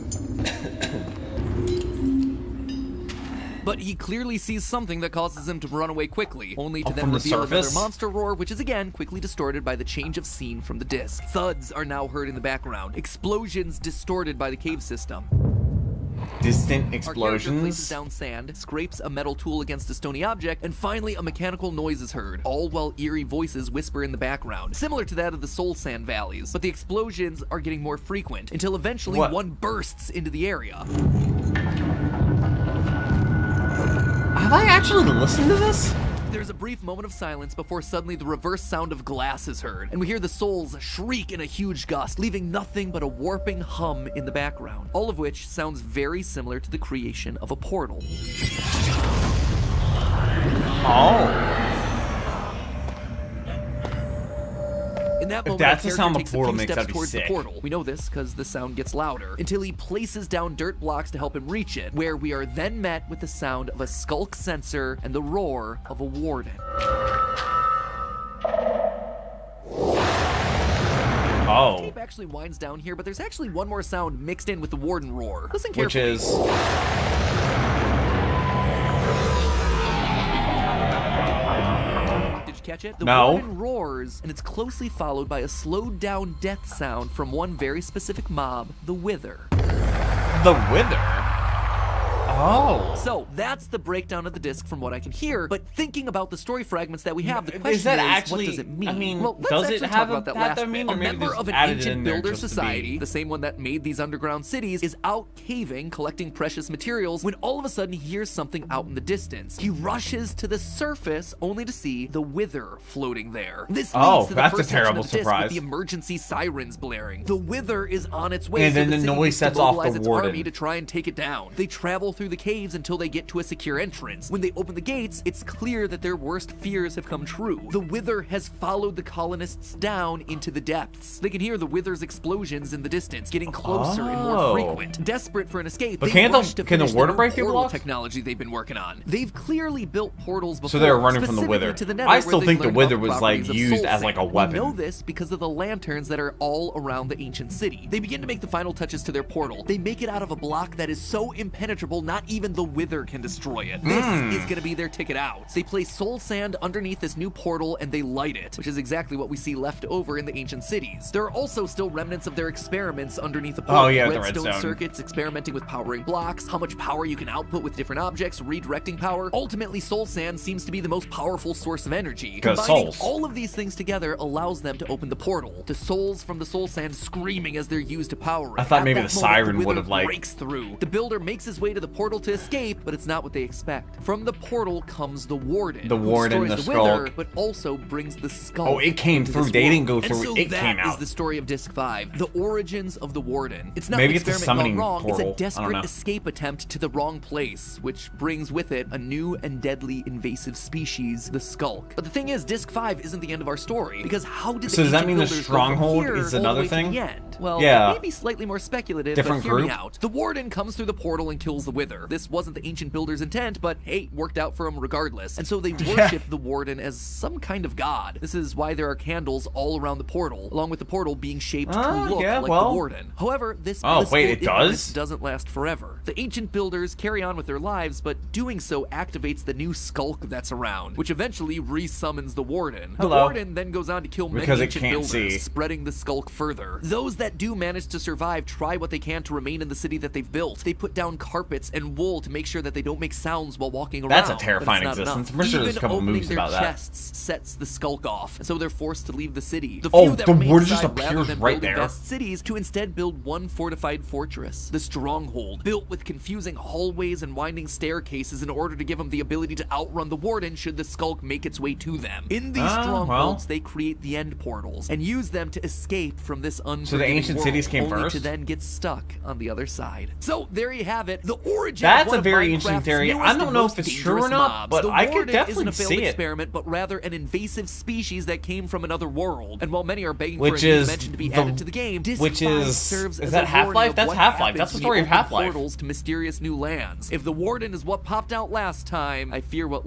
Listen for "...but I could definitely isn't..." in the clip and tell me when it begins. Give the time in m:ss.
4:34.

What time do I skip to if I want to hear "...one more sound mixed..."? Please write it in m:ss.
1:13.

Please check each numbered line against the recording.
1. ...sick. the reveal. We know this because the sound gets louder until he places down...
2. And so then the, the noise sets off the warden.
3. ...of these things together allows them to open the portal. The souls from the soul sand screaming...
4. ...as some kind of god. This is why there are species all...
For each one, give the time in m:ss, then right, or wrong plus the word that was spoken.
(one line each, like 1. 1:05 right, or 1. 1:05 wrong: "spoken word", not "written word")
1. 0:57 wrong: "portal", not "reveal"
2. 1:58 right
3. 2:53 right
4. 3:36 wrong: "candles", not "species".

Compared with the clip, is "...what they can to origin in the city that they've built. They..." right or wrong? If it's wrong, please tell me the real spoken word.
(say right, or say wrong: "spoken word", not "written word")
wrong: "remain", not "origin".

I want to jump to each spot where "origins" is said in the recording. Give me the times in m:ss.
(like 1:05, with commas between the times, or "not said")
3:12, 4:31.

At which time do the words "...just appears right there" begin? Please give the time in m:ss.
4:10.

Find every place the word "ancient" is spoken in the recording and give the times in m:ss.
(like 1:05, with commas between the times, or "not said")
1:41, 2:27, 2:40, 3:32, 3:46, 3:54, 4:27.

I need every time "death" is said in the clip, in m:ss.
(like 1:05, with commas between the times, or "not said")
1:26.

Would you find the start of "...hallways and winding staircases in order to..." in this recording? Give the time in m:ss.
4:16.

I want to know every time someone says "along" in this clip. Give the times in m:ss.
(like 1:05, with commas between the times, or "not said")
3:40.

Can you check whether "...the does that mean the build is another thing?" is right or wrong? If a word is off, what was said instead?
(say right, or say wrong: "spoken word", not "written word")
wrong: "stronghold", not "build".